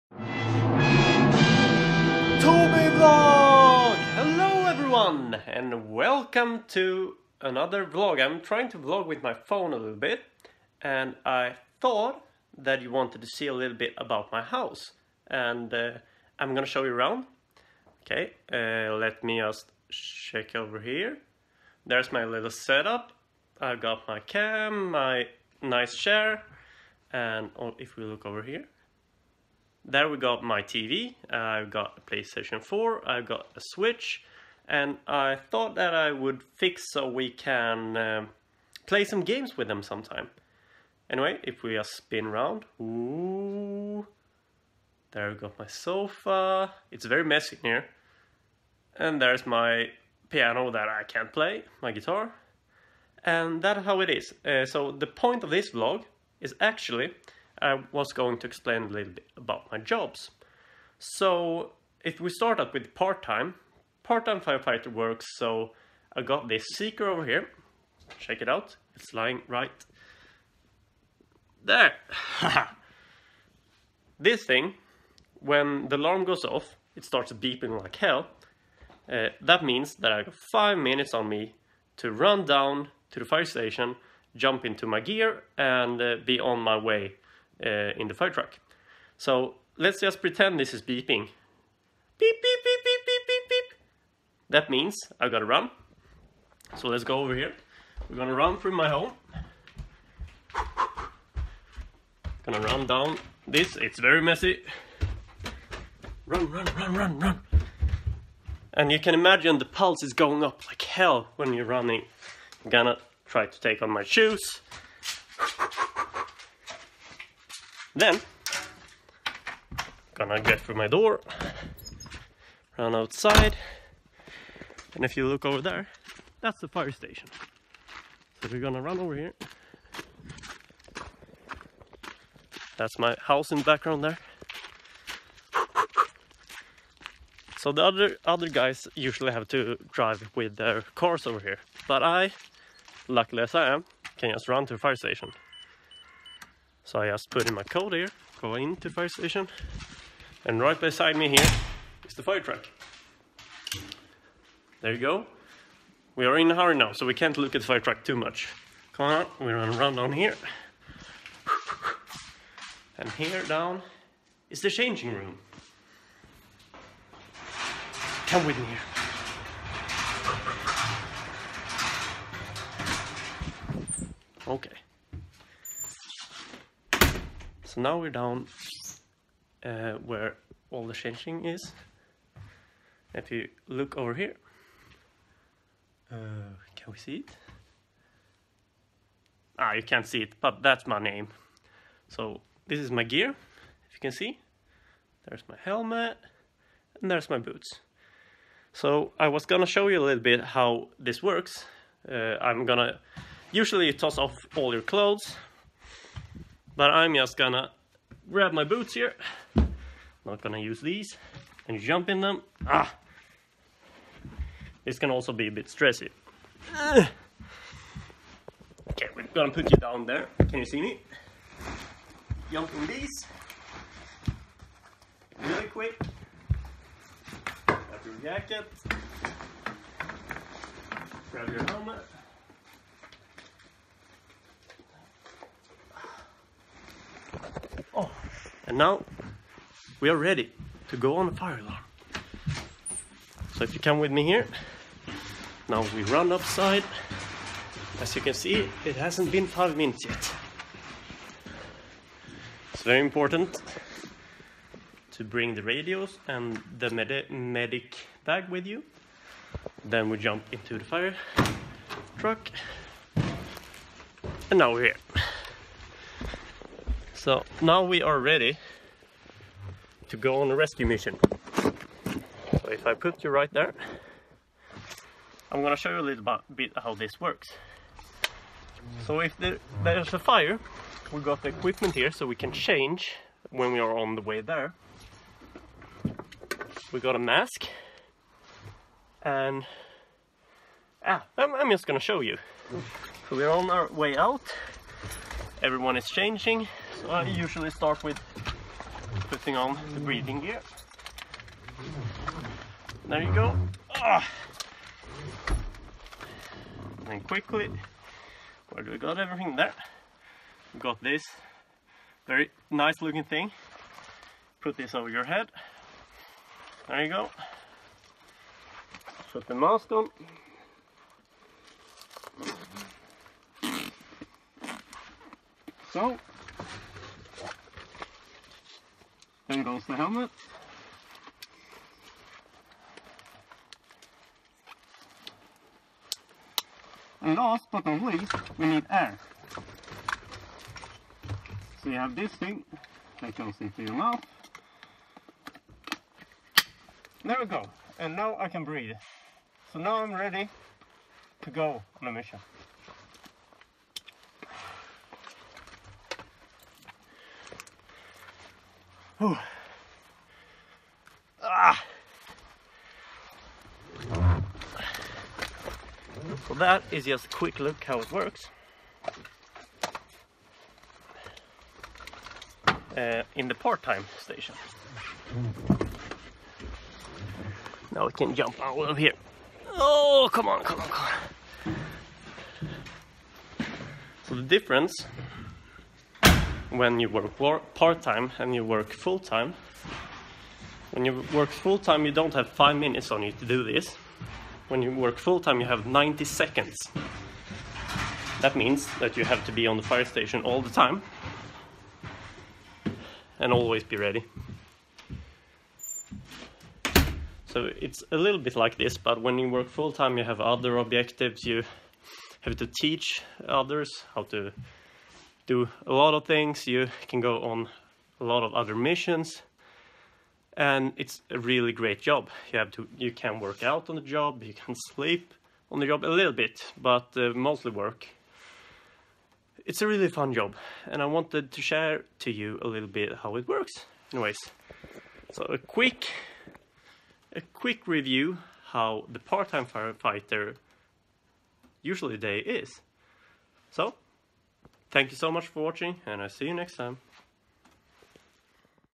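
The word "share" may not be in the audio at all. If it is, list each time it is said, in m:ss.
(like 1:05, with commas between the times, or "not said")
7:11.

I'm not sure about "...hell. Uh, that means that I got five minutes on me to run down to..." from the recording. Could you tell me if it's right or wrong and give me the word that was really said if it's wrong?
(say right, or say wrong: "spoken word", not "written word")
right.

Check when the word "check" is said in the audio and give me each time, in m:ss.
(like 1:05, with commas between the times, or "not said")
0:19, 1:08.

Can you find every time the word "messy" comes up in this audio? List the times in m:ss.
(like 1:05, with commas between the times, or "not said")
0:47, 1:44.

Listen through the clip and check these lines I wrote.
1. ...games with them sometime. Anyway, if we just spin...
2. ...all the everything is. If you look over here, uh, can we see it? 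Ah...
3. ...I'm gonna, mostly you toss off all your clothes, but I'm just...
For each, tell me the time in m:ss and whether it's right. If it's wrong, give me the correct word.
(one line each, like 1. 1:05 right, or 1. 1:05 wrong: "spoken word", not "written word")
1. 0:39 right
2. 3:00 wrong: "changing", not "everything"
3. 3:22 wrong: "usually", not "mostly".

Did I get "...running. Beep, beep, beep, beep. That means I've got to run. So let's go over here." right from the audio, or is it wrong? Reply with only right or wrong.
wrong.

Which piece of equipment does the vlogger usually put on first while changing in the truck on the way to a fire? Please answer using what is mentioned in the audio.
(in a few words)
breathing gear.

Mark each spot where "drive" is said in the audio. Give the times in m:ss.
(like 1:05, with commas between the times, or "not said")
2:19.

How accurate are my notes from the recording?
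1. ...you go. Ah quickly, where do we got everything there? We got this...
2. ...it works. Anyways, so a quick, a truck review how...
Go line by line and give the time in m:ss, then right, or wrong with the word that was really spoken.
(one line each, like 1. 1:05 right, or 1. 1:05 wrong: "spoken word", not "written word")
1. 5:03 right
2. 7:13 wrong: "quick", not "truck".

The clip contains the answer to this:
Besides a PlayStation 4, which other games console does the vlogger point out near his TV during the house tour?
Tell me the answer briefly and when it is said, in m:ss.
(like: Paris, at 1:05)
Switch, at 0:33.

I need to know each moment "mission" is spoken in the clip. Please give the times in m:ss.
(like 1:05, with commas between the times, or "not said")
4:30, 5:52, 6:58.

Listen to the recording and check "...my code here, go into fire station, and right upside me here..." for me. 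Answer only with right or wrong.
wrong.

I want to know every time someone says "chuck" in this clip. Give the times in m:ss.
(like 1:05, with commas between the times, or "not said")
not said.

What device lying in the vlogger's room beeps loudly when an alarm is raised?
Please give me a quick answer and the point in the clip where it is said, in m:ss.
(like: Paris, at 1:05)
seeker, at 1:06.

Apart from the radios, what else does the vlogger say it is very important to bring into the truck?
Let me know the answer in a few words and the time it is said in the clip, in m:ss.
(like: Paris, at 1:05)
medic bag, at 4:17.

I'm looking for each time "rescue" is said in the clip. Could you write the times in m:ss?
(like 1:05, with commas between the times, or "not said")
4:30.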